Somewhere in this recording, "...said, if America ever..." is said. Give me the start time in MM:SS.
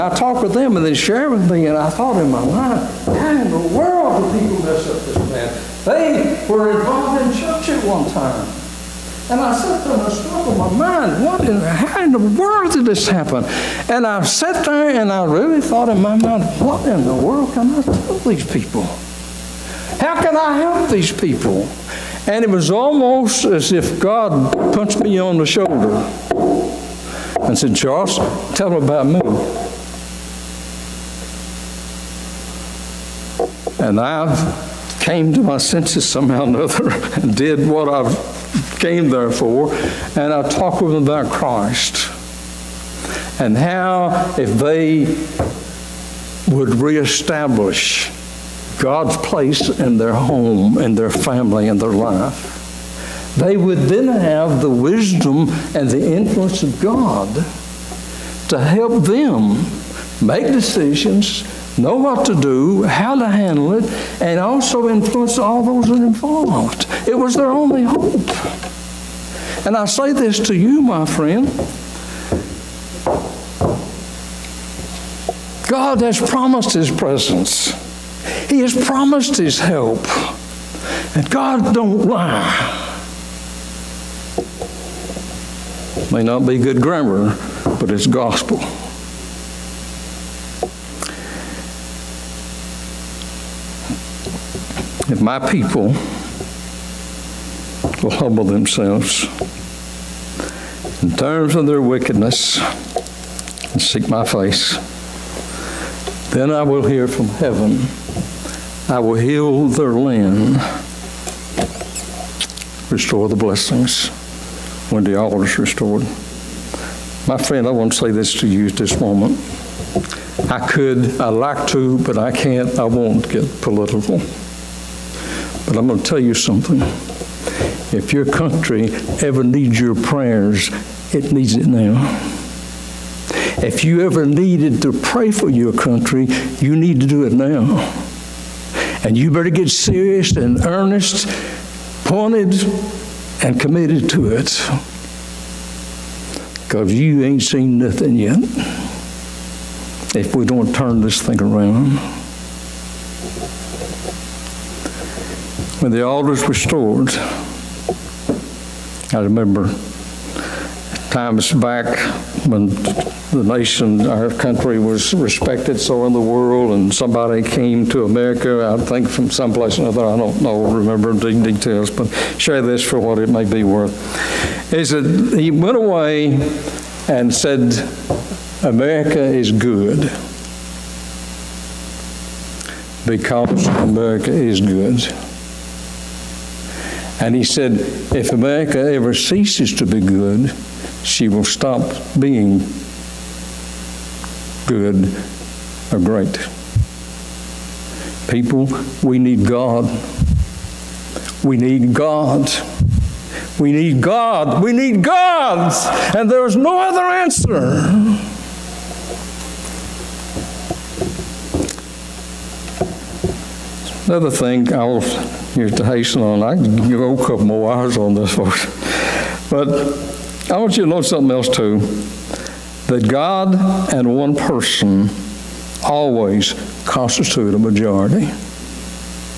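03:07.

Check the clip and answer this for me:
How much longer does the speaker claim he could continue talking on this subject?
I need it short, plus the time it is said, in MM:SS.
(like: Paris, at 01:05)
a couple more hours, at 03:37.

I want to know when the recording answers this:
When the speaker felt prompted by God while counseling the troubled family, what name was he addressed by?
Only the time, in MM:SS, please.
00:27.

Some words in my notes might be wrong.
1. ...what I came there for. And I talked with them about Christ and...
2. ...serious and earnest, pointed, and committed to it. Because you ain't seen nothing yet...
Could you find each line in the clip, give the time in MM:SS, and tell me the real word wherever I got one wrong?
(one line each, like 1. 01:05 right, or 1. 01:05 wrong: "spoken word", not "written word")
1. 00:37 right
2. 02:19 right.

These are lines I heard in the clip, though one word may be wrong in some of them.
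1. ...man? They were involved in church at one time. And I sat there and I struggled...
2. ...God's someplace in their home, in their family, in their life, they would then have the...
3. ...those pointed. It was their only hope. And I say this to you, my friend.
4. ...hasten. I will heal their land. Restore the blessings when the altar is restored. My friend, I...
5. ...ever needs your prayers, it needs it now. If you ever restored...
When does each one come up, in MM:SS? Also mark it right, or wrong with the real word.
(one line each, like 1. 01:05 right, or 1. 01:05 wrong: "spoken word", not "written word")
1. 00:05 right
2. 00:48 wrong: "place", not "someplace"
3. 01:05 wrong: "involved", not "pointed"
4. 01:47 wrong: "heaven", not "hasten"
5. 02:09 wrong: "needed", not "restored".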